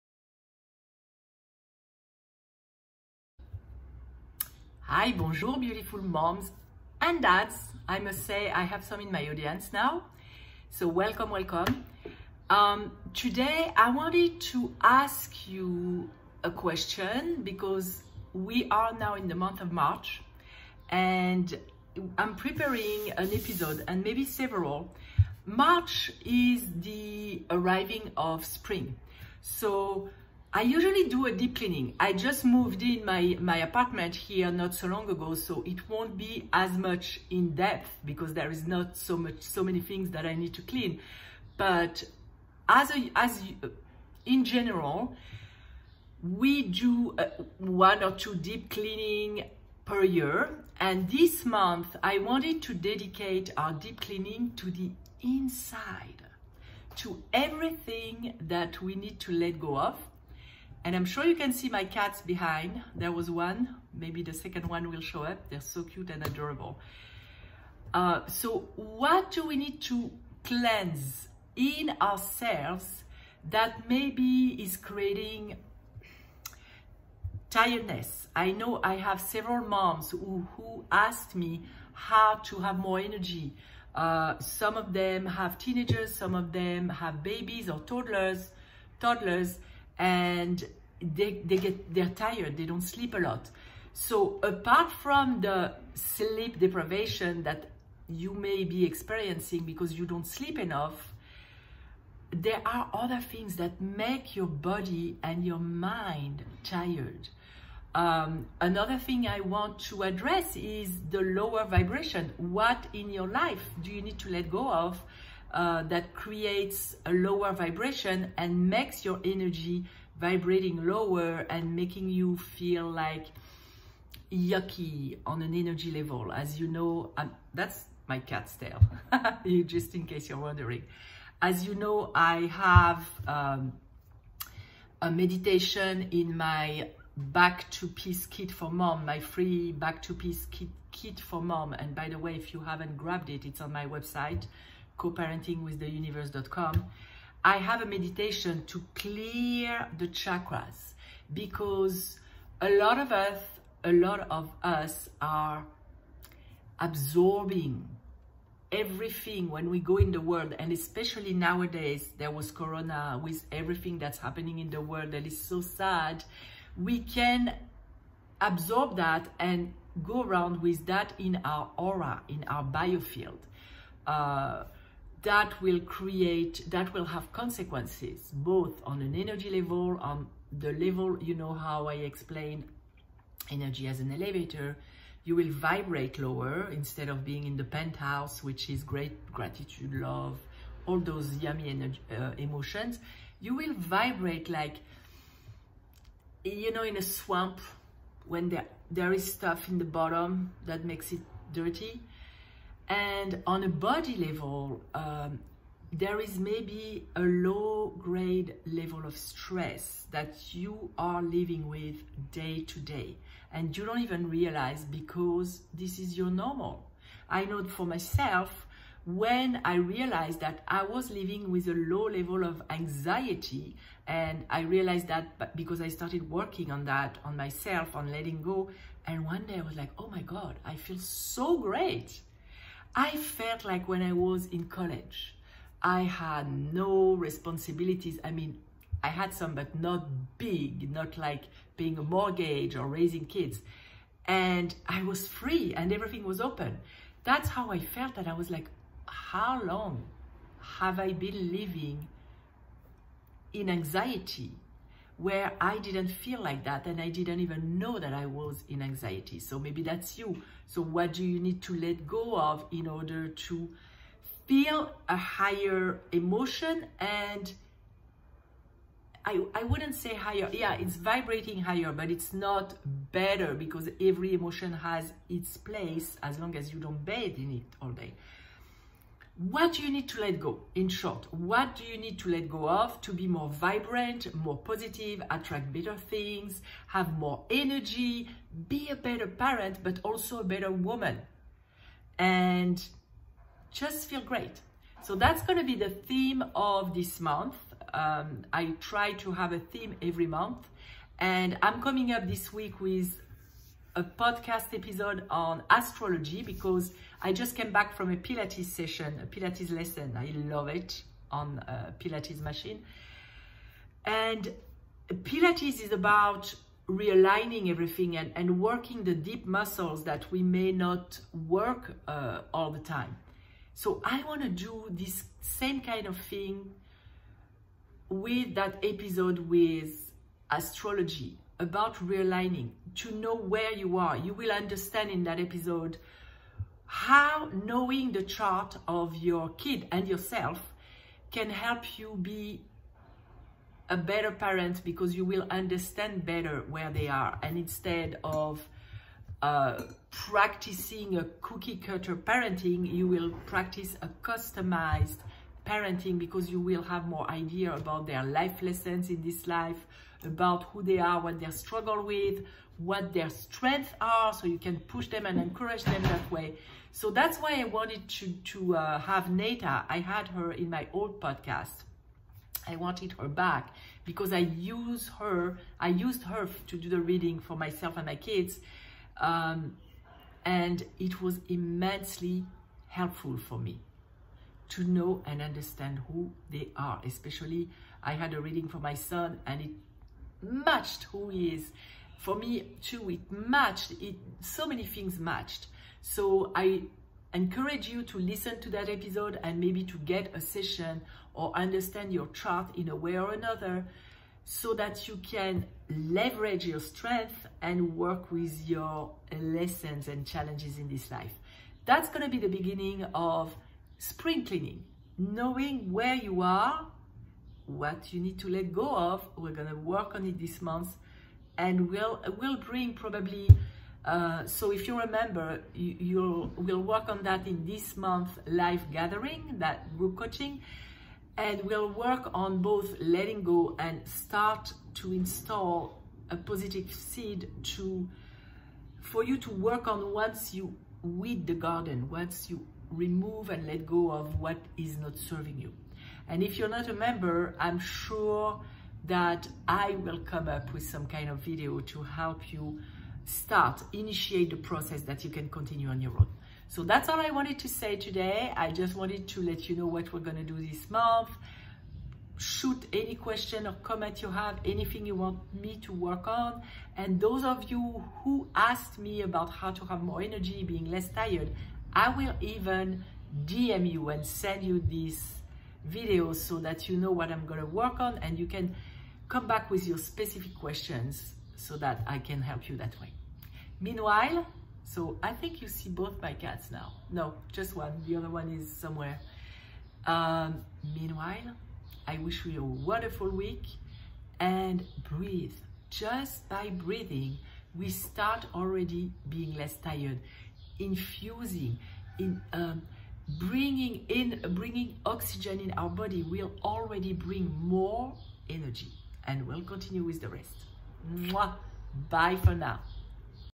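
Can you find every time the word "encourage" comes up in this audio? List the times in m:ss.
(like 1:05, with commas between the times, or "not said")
6:05, 6:37.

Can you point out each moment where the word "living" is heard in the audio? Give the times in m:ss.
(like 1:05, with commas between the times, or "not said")
3:31, 3:41, 4:11.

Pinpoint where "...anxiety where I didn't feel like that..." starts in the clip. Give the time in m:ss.
4:13.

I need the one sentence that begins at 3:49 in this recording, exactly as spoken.
And one day I was like, oh my God, I feel so great.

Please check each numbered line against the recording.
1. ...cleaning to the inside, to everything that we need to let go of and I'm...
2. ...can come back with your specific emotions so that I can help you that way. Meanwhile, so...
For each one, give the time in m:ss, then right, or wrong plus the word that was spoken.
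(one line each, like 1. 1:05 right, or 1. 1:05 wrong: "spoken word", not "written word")
1. 0:54 right
2. 7:58 wrong: "questions", not "emotions".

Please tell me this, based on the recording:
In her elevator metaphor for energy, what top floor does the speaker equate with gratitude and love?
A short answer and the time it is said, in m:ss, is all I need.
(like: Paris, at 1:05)
penthouse, at 3:07.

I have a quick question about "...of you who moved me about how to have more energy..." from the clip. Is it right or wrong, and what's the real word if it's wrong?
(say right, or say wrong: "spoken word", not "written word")
wrong: "asked", not "moved".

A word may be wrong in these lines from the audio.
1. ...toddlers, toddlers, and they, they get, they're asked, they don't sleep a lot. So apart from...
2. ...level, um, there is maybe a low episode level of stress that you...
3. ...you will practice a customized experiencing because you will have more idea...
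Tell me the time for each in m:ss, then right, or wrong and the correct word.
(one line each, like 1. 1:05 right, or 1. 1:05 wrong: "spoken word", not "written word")
1. 1:27 wrong: "tired", not "asked"
2. 3:24 wrong: "grade", not "episode"
3. 5:52 wrong: "parenting", not "experiencing".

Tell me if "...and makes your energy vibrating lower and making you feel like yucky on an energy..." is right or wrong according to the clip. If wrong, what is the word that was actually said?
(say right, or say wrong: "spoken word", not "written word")
right.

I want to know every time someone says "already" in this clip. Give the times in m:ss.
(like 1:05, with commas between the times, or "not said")
8:18, 8:26.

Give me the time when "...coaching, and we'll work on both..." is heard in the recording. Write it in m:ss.
7:10.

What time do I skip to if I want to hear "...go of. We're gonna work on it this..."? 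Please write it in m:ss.
6:58.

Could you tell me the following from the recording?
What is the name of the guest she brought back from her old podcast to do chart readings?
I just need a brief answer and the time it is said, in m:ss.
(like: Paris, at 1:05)
Neta, at 6:09.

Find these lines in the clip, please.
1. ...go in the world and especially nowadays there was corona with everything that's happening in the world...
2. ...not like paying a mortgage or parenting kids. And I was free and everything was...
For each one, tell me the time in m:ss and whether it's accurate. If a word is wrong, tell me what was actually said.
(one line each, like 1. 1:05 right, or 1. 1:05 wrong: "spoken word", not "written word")
1. 2:39 right
2. 4:00 wrong: "raising", not "parenting".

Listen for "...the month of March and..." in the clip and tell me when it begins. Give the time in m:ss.
0:19.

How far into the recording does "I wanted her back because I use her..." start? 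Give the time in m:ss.
6:12.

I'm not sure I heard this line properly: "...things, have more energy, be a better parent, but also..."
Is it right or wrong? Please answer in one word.
right.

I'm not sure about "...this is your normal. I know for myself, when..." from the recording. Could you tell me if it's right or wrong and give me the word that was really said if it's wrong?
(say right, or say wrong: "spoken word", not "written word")
right.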